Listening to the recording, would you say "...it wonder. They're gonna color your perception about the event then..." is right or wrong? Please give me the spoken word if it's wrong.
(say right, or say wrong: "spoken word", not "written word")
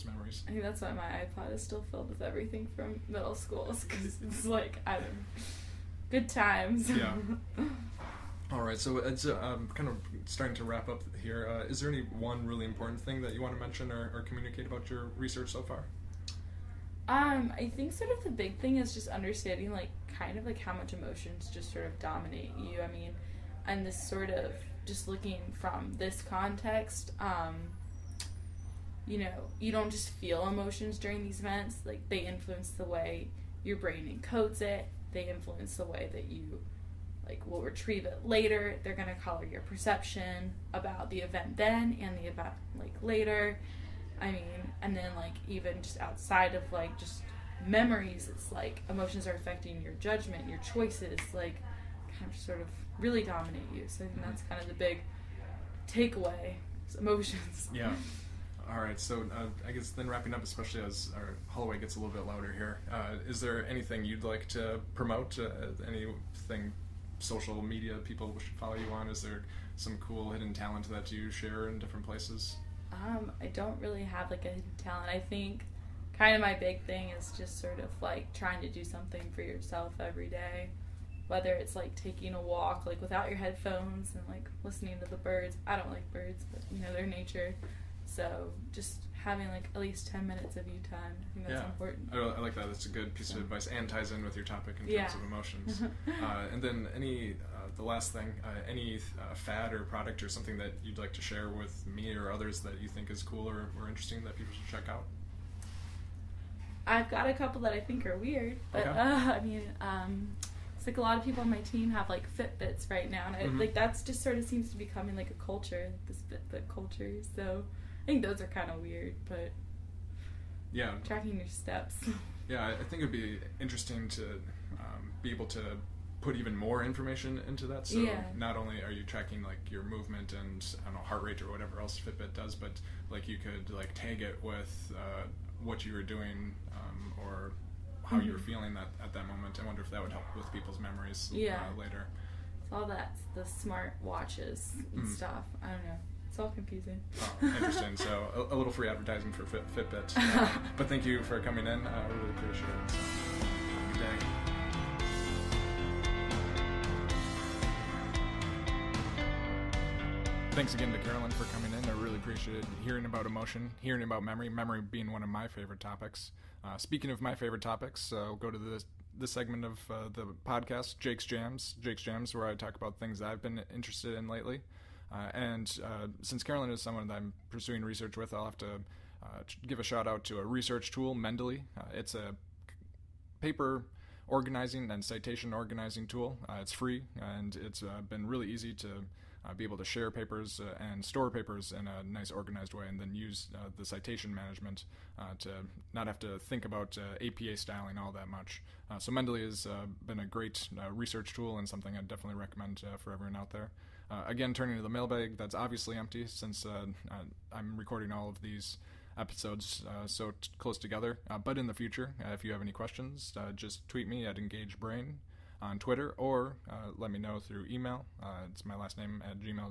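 wrong: "later", not "wonder".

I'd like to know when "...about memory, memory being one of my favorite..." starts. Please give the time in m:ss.
2:44.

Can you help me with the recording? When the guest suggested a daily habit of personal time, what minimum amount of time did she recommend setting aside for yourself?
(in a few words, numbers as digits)
10 minutes.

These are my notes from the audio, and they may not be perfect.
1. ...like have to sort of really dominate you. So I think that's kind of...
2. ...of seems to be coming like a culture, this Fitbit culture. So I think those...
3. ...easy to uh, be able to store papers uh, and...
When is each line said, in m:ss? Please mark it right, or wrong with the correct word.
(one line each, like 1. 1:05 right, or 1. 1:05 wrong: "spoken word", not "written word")
1. 0:51 right
2. 1:54 right
3. 3:08 wrong: "share", not "store".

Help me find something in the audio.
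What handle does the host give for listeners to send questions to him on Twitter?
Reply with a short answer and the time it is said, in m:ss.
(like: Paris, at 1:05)
EngageBrain, at 3:34.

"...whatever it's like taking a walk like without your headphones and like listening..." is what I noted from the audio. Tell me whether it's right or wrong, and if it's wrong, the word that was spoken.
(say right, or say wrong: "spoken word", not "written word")
wrong: "whether", not "whatever".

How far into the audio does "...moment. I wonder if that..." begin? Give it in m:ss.
2:19.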